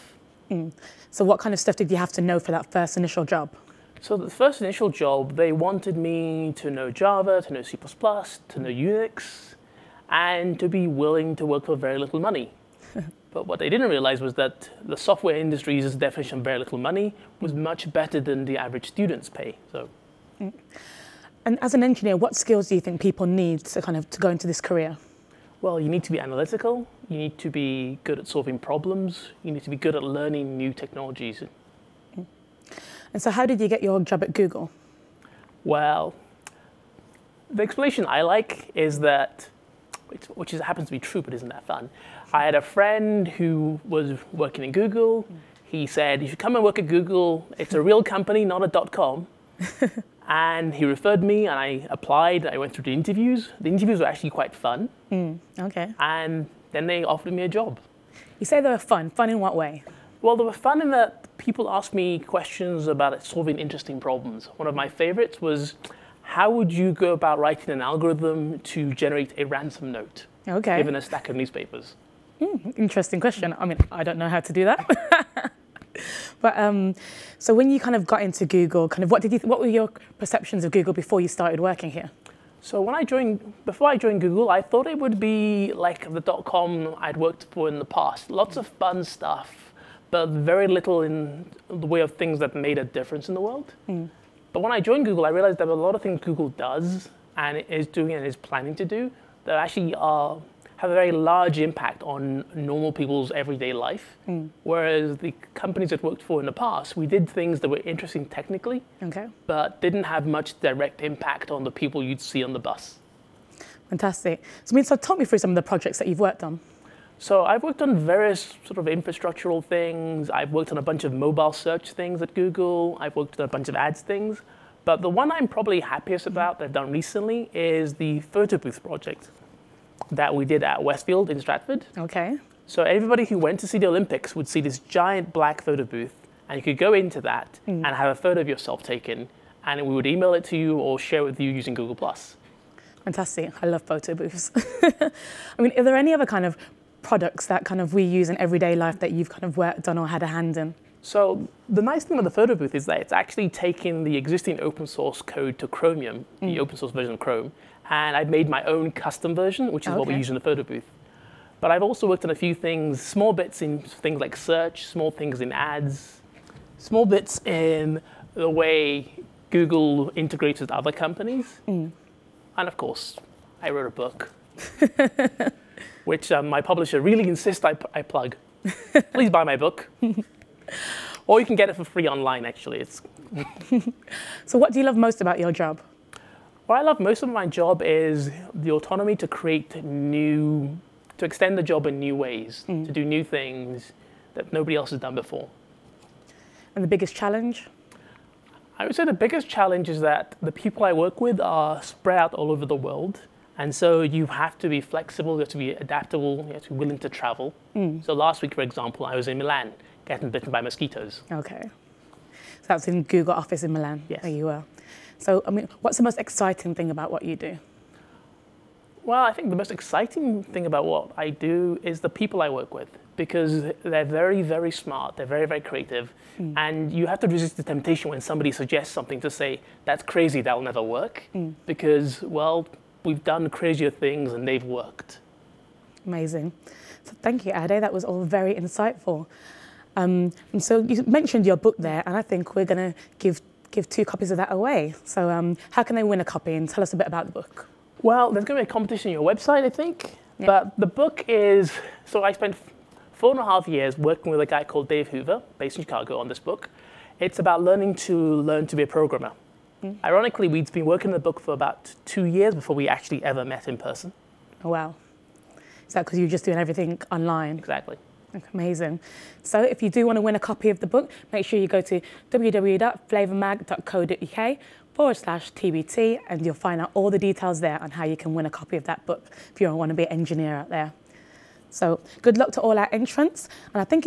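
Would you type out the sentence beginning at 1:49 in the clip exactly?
but didn't have much direct impact on the people you'd see on the bus.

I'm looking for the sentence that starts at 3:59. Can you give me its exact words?
Um, and so you mentioned your book there, and I think we're going to give give two copies of that away.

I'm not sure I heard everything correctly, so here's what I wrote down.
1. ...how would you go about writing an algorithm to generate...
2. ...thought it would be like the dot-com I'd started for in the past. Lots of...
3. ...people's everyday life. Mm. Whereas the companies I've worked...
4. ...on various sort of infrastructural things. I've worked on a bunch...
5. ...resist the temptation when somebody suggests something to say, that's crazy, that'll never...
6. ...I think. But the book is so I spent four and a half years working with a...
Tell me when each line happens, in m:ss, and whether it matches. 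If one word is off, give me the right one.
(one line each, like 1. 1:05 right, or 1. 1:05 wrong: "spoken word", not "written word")
1. 1:06 right
2. 1:24 wrong: "worked", not "started"
3. 1:42 right
4. 1:57 right
5. 3:47 right
6. 4:09 right.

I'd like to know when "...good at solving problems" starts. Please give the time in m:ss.
0:28.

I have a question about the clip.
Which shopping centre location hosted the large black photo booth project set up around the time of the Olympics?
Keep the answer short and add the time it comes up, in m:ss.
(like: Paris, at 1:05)
Westfield in Stratford, at 2:10.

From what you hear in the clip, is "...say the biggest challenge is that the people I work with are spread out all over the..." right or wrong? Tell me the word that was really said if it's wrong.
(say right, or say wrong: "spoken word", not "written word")
right.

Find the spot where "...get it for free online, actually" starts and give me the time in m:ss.
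3:01.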